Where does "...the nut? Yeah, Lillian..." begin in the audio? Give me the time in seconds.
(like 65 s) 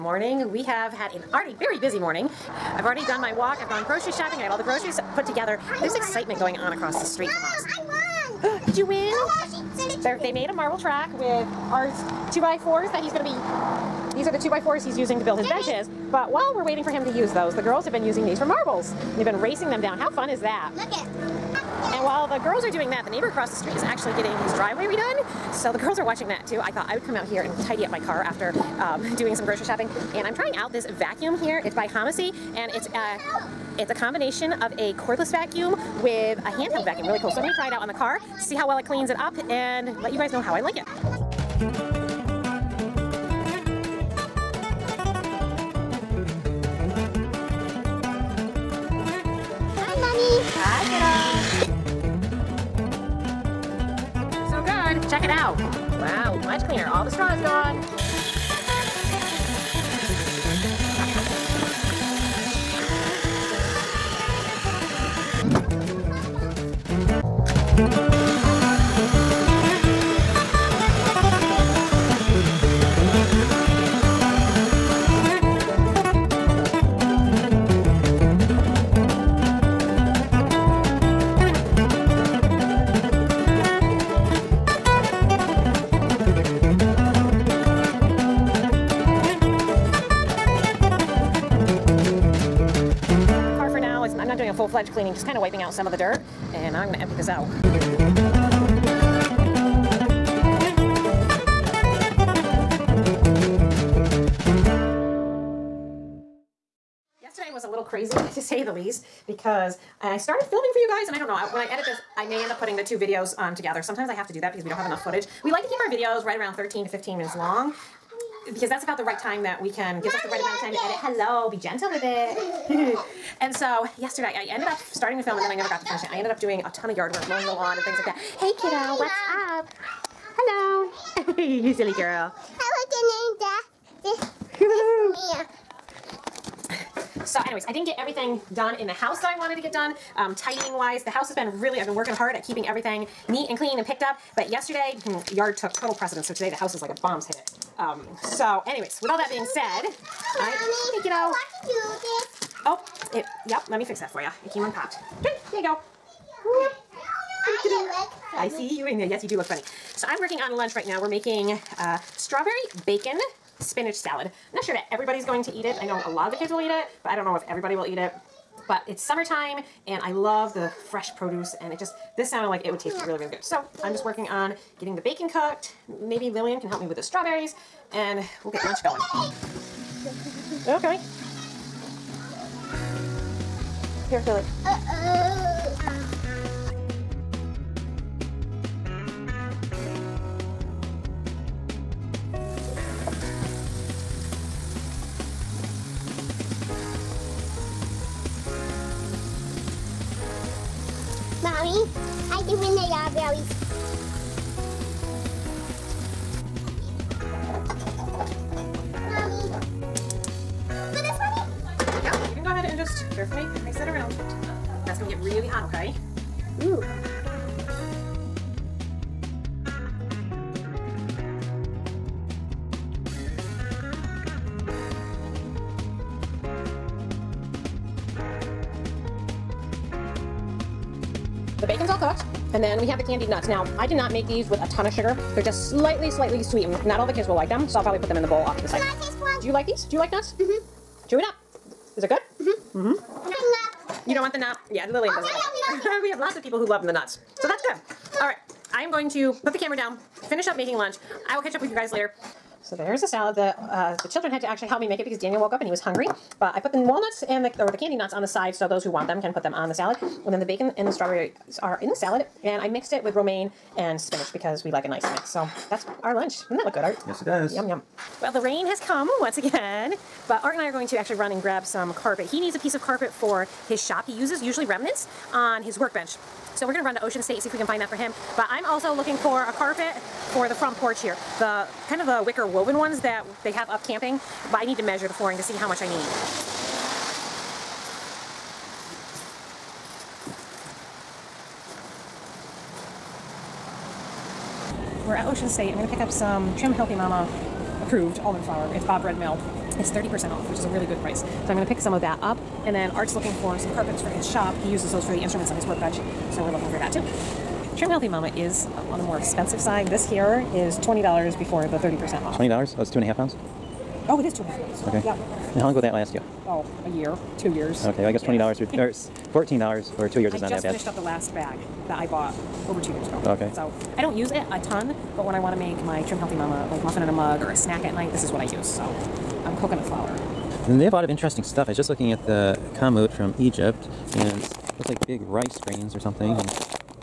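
244 s.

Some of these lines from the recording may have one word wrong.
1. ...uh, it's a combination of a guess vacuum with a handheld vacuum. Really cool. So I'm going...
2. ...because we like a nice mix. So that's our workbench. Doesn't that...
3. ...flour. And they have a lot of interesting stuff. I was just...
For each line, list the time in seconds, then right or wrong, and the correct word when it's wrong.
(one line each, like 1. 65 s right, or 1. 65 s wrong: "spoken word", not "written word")
1. 32 s wrong: "cordless", not "guess"
2. 264 s wrong: "lunch", not "workbench"
3. 329 s right.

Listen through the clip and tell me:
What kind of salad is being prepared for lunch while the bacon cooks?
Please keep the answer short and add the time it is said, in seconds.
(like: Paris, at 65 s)
strawberry bacon spinach salad, at 162 s.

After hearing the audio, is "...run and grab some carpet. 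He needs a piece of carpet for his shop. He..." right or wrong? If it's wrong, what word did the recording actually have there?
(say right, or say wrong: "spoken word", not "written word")
right.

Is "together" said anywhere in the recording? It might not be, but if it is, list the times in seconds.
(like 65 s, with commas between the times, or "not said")
5 s, 113 s.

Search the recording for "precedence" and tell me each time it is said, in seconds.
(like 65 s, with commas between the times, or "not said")
145 s.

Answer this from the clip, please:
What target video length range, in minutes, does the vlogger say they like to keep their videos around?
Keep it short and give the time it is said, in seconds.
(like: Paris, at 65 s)
13 to 15, at 116 s.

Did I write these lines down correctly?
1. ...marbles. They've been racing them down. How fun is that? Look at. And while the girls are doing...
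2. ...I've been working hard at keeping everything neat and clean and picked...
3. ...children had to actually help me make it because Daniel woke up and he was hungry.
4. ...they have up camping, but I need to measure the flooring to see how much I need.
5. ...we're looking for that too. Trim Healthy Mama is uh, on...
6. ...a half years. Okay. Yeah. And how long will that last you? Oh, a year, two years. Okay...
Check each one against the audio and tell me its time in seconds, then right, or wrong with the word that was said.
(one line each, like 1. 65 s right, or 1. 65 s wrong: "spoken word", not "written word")
1. 18 s right
2. 141 s right
3. 254 s right
4. 283 s right
5. 306 s right
6. 314 s right.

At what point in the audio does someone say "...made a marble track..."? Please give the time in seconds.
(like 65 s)
10 s.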